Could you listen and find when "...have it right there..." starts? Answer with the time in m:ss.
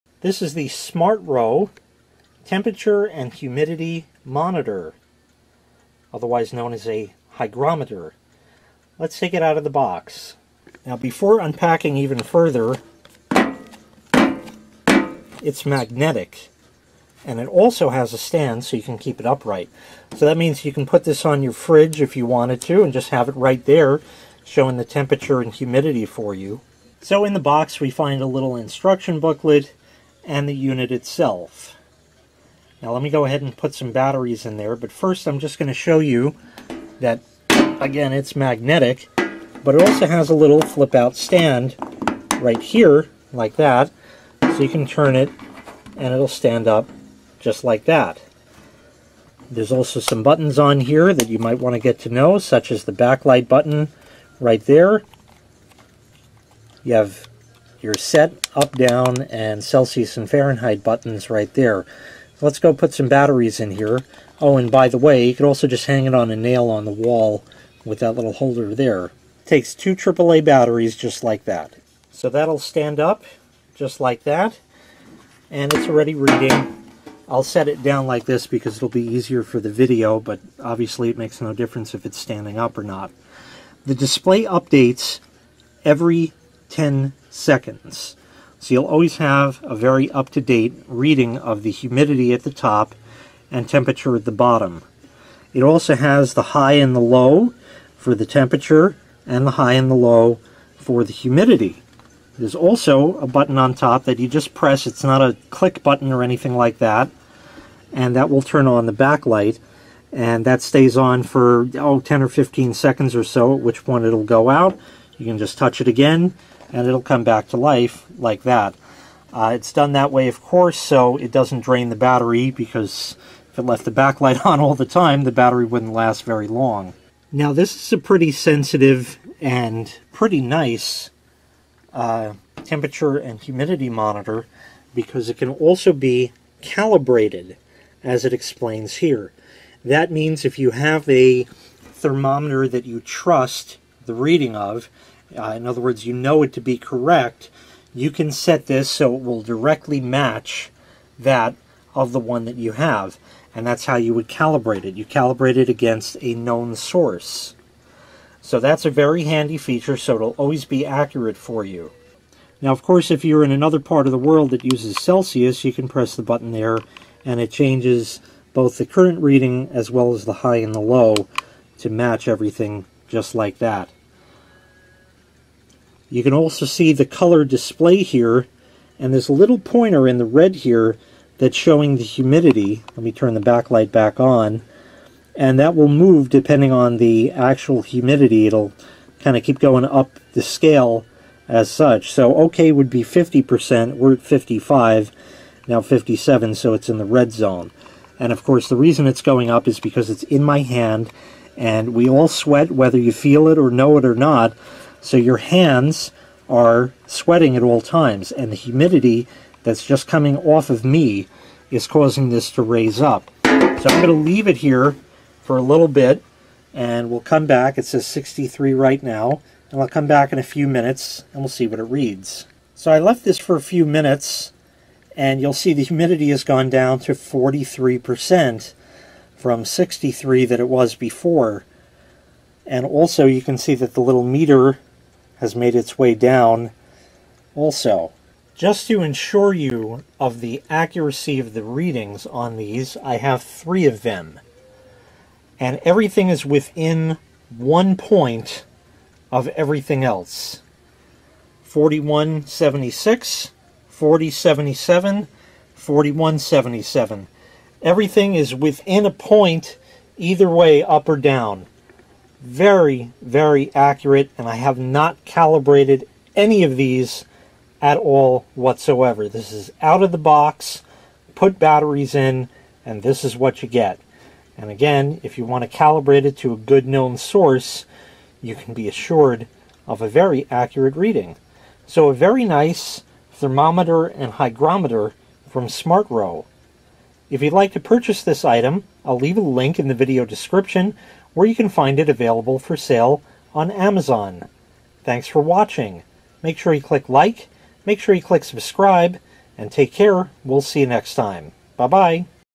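0:23.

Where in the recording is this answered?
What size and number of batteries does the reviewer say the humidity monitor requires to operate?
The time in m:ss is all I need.
1:09.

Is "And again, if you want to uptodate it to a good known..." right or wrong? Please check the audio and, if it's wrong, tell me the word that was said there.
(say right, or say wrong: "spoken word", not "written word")
wrong: "calibrate", not "uptodate".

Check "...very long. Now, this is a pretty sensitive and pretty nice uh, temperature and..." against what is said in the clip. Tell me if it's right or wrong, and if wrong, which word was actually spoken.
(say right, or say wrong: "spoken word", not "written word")
right.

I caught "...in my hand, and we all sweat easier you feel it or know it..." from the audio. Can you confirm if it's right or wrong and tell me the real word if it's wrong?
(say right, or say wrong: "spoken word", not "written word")
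wrong: "whether", not "easier".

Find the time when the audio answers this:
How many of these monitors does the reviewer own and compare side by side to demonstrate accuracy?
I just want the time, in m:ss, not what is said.
4:03.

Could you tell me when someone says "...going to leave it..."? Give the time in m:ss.
3:34.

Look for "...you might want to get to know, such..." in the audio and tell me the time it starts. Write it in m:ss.
0:51.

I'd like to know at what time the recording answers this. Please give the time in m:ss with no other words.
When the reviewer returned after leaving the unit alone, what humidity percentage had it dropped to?
3:47.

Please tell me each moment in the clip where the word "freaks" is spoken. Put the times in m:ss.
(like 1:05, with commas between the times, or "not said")
not said.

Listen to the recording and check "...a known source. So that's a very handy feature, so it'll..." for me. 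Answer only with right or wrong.
right.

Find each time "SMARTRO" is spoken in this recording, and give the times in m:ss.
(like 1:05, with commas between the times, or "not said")
0:00, 4:45.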